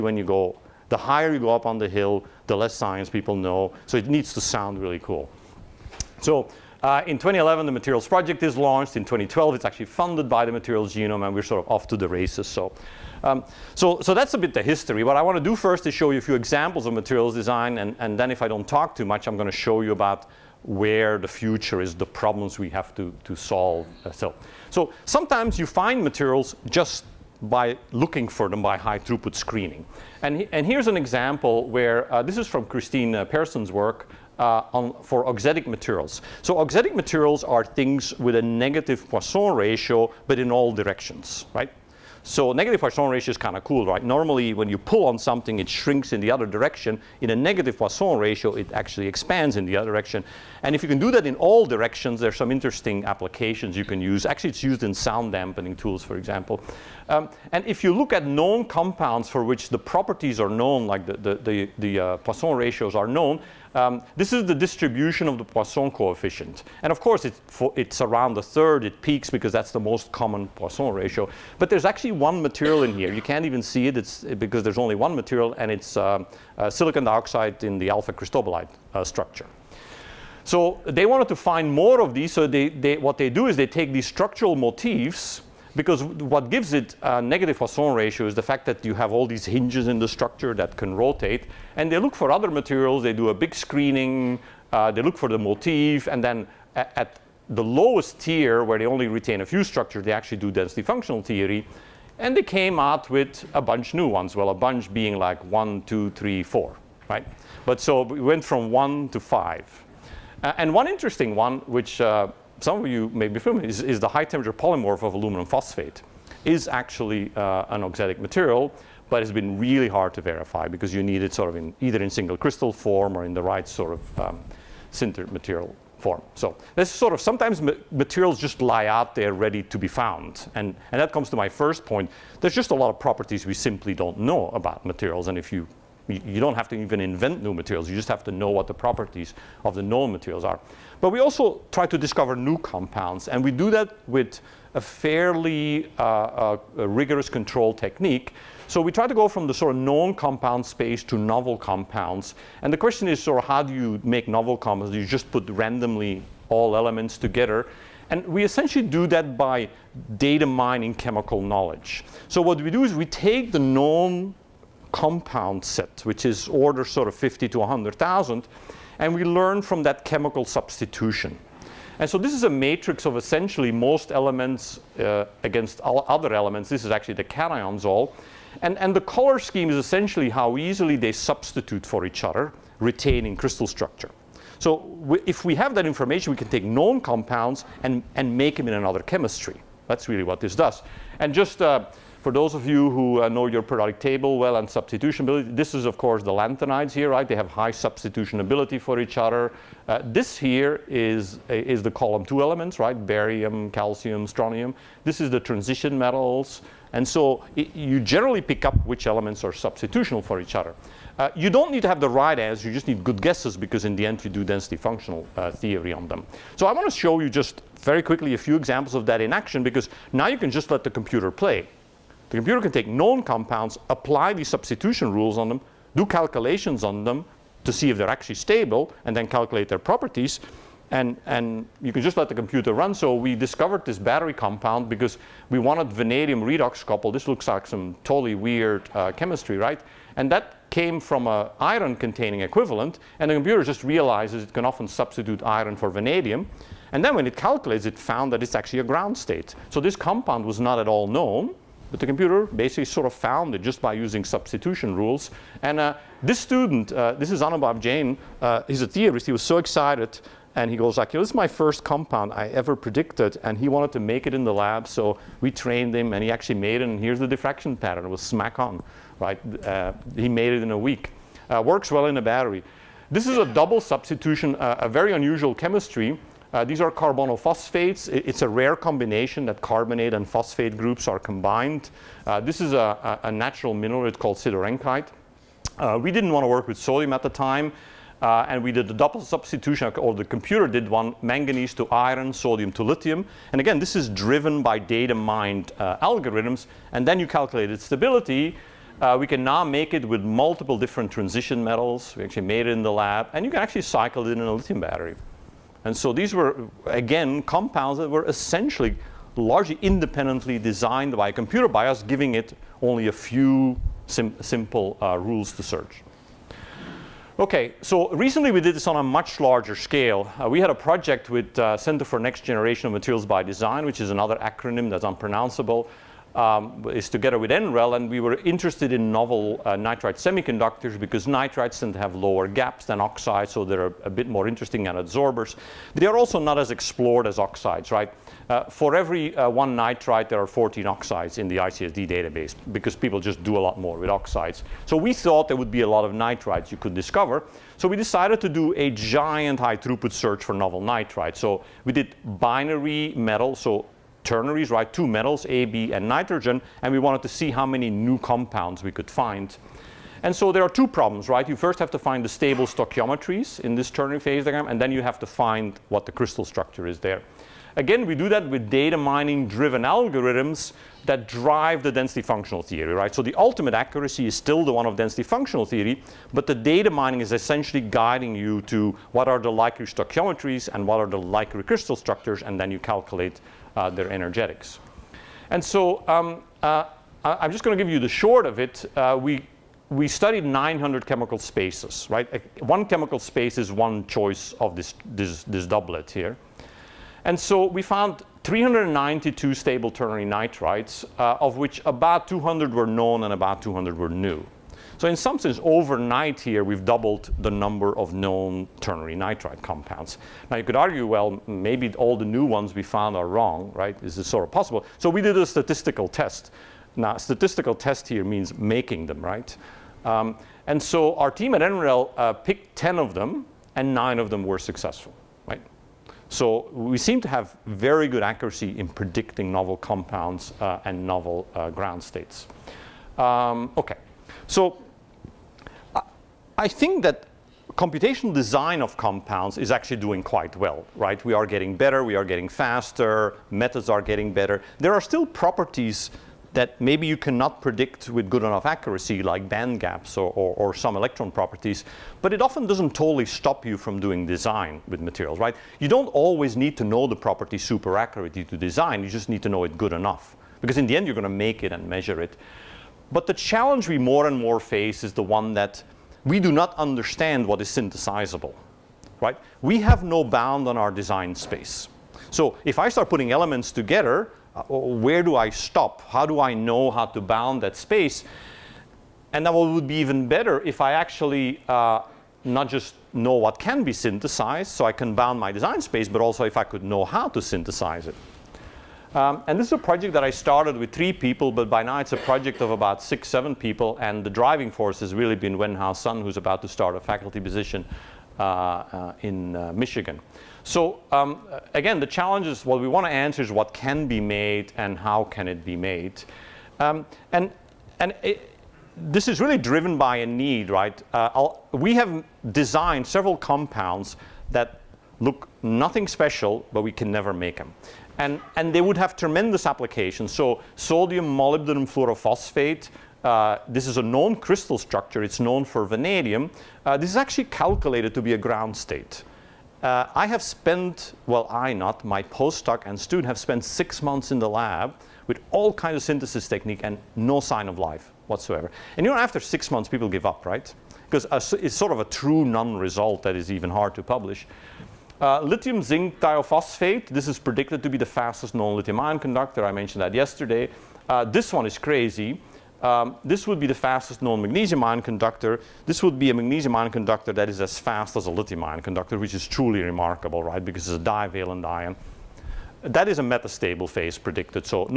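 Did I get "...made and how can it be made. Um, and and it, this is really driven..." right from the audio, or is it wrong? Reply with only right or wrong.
right.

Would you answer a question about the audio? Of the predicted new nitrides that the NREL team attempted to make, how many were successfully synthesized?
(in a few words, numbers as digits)
9.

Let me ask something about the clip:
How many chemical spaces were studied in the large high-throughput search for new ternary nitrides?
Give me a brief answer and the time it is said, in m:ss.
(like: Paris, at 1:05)
900, at 6:30.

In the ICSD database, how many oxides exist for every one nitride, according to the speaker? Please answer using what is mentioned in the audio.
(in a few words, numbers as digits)
14.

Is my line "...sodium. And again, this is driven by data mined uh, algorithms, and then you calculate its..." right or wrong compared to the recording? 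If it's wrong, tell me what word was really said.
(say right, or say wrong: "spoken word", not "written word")
wrong: "lithium", not "sodium".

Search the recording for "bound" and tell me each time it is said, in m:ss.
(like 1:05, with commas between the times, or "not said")
7:50, 7:57, 8:05.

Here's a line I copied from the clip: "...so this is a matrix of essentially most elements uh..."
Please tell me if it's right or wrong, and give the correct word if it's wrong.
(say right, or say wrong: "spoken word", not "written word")
right.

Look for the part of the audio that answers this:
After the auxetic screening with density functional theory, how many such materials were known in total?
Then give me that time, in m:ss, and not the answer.
1:48.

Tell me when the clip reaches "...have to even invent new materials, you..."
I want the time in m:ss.
2:16.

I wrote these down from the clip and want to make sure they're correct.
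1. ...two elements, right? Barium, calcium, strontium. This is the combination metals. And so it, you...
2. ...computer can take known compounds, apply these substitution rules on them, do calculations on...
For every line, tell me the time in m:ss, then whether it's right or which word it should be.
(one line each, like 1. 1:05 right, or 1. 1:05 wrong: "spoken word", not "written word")
1. 3:22 wrong: "transition", not "combination"
2. 3:42 right.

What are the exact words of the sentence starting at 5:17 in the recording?
Okay, so recently we did this on a much larger scale.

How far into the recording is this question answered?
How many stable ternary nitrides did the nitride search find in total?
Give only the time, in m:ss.
6:38.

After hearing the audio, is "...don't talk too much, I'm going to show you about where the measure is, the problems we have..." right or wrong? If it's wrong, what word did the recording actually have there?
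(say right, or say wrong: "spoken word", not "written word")
wrong: "future", not "measure".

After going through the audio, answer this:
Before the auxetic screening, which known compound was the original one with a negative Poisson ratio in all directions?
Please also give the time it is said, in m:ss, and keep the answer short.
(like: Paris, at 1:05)
silicon dioxide, at 1:16.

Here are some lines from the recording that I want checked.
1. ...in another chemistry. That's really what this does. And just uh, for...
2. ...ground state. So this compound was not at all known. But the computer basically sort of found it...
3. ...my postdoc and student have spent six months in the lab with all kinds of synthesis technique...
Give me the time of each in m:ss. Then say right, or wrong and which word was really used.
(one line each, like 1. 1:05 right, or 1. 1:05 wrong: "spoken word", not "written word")
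1. 3:08 right
2. 4:08 right
3. 8:52 right.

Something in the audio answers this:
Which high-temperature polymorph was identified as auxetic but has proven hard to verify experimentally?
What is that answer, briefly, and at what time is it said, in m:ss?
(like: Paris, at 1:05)
aluminum phosphate, at 1:55.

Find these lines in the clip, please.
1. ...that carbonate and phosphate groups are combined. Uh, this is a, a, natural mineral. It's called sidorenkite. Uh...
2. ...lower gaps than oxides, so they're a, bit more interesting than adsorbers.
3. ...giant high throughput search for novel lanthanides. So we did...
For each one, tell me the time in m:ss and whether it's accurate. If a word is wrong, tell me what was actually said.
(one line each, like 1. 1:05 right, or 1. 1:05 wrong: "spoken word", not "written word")
1. 4:39 right
2. 5:32 right
3. 5:48 wrong: "nitrides", not "lanthanides".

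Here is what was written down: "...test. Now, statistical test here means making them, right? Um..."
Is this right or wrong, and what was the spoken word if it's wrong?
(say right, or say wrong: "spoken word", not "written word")
right.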